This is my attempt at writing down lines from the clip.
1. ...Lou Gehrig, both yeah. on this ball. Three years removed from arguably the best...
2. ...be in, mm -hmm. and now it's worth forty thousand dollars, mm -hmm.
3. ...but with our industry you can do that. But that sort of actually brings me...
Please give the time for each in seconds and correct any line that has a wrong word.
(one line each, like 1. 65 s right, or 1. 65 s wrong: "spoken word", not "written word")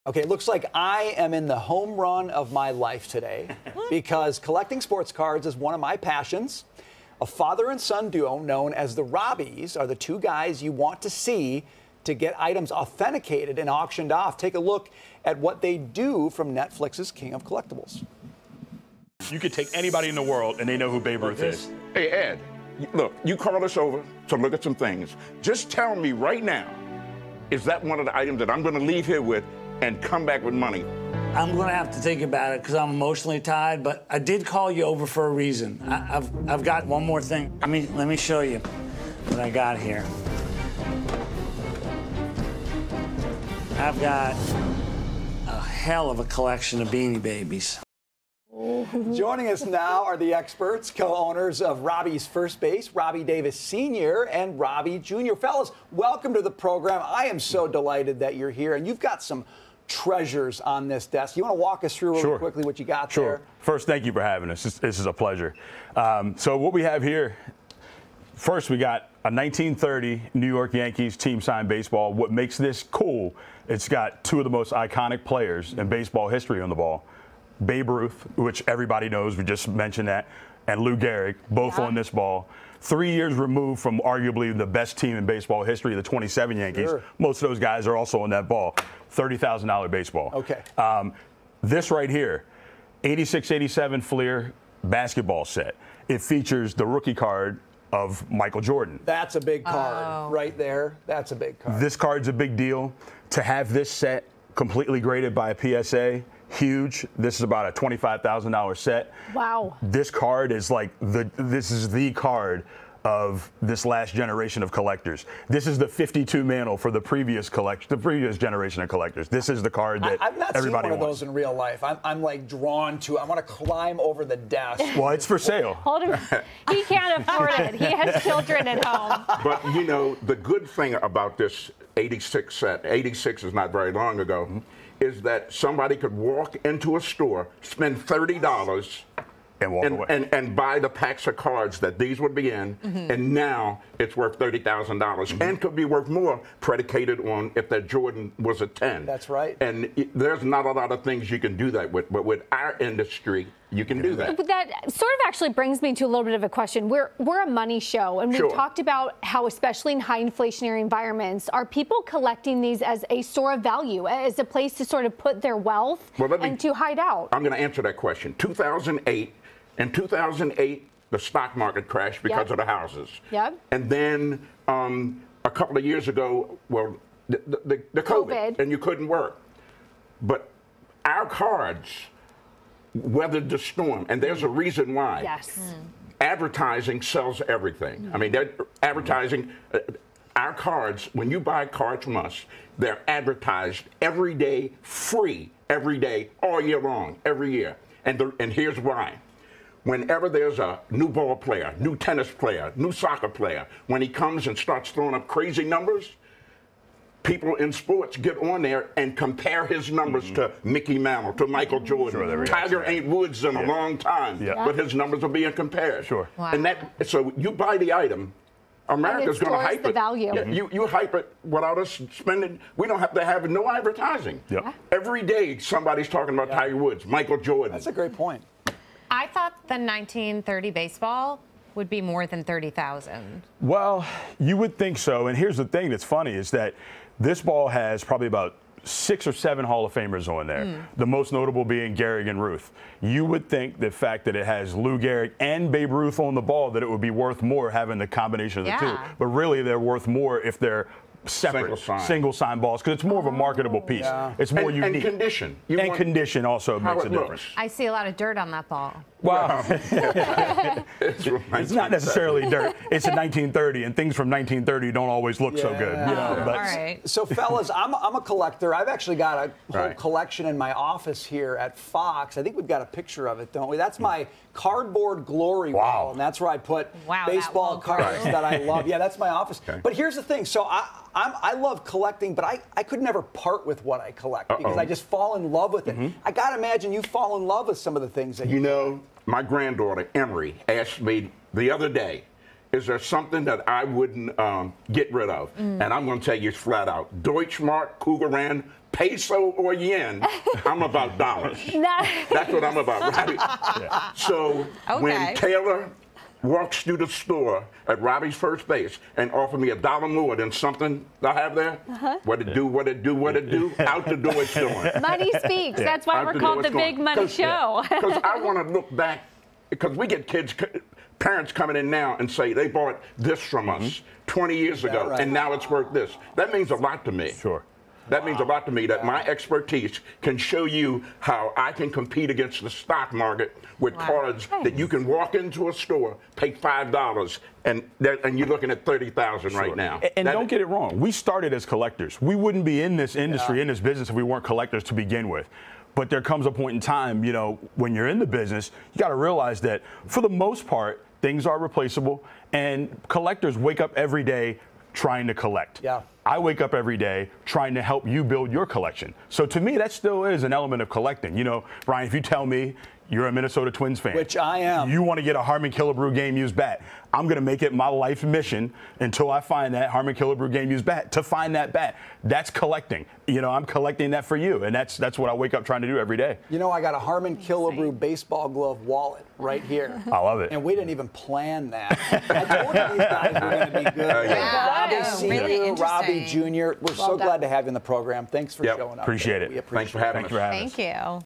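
1. 80 s right
2. 142 s wrong: "thirty", not "forty"
3. 152 s right.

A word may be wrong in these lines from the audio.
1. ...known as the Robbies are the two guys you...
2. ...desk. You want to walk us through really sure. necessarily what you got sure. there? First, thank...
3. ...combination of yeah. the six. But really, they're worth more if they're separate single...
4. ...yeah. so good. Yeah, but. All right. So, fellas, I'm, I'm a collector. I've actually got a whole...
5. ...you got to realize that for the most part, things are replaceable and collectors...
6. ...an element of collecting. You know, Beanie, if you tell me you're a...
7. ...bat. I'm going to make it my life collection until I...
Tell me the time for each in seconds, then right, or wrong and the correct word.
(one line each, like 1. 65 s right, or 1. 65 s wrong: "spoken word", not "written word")
1. 8 s right
2. 61 s wrong: "quickly", not "necessarily"
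3. 248 s wrong: "two", not "six"
4. 265 s right
5. 348 s right
6. 360 s wrong: "Brian", not "Beanie"
7. 366 s wrong: "mission", not "collection".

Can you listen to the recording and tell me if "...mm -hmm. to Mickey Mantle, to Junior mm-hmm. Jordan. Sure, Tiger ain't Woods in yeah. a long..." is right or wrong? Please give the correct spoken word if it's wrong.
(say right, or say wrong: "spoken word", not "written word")
wrong: "Michael", not "Junior".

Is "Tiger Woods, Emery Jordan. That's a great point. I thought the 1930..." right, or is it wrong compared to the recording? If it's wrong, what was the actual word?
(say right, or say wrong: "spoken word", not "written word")
wrong: "Michael", not "Emery".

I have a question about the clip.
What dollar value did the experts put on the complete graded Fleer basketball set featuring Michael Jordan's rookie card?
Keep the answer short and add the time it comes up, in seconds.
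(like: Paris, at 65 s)
$25,000, at 107 s.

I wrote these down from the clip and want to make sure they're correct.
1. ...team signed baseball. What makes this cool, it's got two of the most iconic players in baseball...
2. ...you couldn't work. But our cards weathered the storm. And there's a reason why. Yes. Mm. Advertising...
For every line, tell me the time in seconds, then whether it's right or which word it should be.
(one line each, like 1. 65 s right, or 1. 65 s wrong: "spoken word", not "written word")
1. 71 s right
2. 178 s right.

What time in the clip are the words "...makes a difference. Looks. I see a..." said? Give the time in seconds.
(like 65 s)
256 s.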